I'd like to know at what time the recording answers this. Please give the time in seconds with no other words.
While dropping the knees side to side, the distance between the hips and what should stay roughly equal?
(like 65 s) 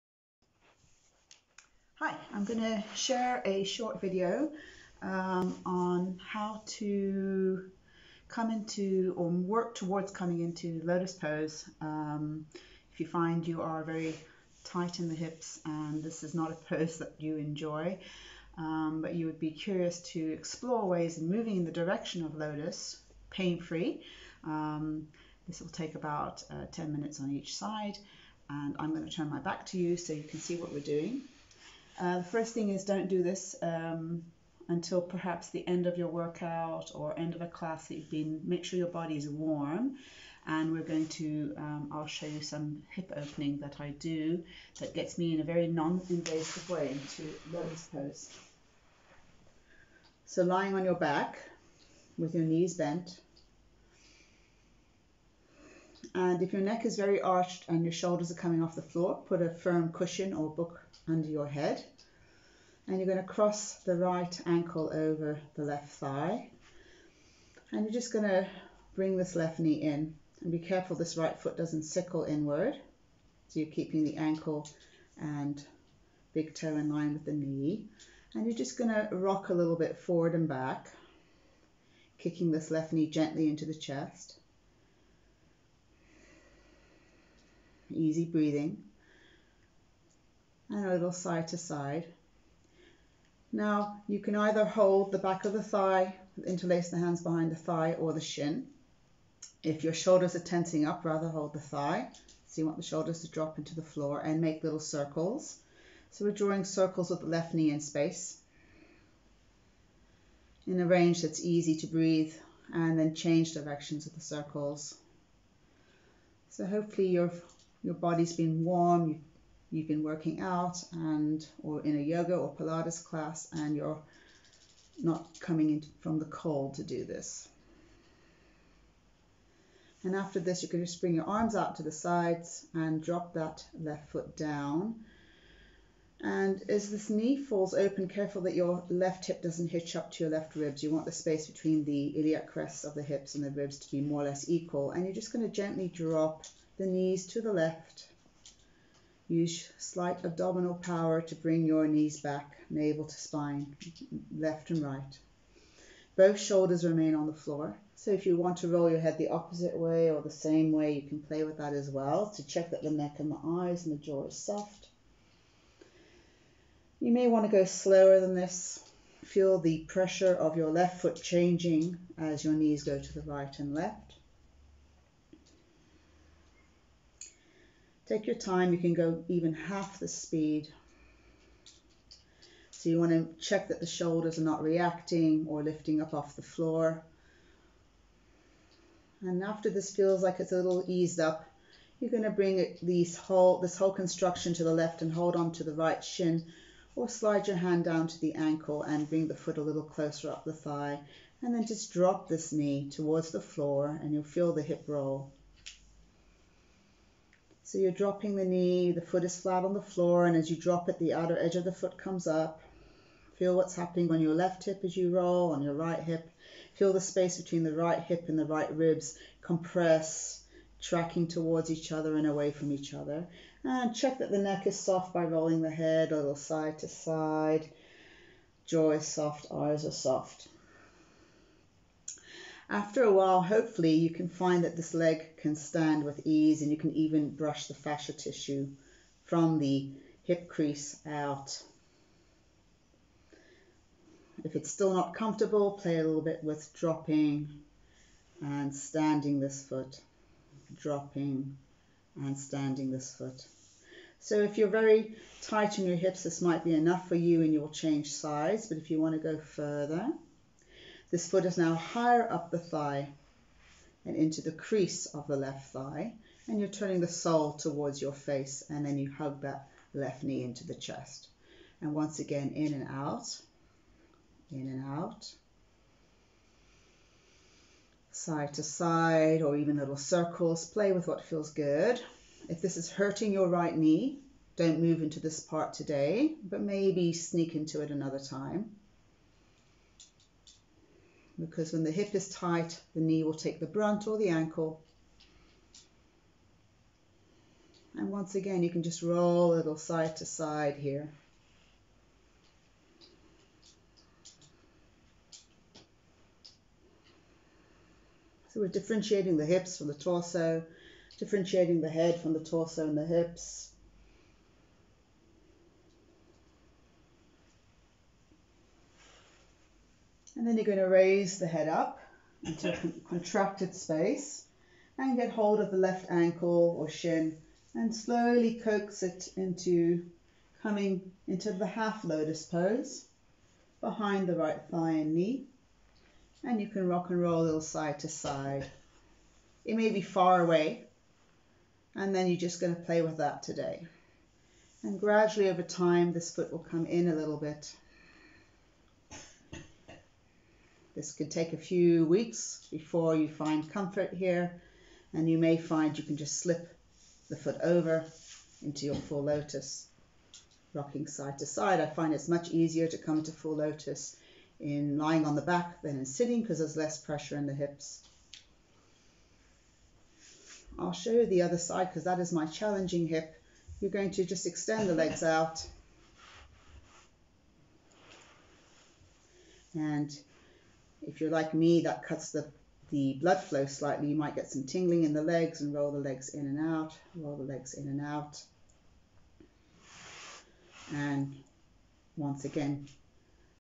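143 s.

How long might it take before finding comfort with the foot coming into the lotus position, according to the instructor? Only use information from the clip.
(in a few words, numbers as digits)
a few weeks.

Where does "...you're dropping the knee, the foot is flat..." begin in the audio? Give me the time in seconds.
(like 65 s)
207 s.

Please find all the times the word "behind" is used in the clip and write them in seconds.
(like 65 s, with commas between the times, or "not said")
97 s, 333 s.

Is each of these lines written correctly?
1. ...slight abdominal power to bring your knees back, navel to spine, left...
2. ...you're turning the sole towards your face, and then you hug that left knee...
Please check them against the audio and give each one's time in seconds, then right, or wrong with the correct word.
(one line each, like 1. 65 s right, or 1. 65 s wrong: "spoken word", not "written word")
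1. 149 s right
2. 266 s right.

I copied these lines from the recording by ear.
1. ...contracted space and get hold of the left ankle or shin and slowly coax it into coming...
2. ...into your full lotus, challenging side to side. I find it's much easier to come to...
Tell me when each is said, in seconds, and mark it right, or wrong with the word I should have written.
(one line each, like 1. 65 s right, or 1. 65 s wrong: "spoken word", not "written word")
1. 323 s right
2. 358 s wrong: "rocking", not "challenging".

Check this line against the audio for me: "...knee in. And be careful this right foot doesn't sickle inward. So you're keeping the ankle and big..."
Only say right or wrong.
right.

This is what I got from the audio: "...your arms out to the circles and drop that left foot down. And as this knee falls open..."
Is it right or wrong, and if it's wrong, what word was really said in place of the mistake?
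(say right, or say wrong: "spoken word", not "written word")
wrong: "sides", not "circles".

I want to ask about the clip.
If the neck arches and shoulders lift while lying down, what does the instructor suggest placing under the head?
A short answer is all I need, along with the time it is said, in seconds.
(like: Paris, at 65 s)
firm cushion or book, at 59 s.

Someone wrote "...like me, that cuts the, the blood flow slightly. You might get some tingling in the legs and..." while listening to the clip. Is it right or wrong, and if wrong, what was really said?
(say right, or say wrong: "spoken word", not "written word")
right.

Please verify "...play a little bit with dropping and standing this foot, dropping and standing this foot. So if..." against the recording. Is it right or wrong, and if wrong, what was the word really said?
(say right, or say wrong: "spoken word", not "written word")
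right.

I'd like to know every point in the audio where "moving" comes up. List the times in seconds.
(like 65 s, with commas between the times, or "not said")
21 s.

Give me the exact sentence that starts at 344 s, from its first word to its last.
And gradually over time, this foot will come in a little bit.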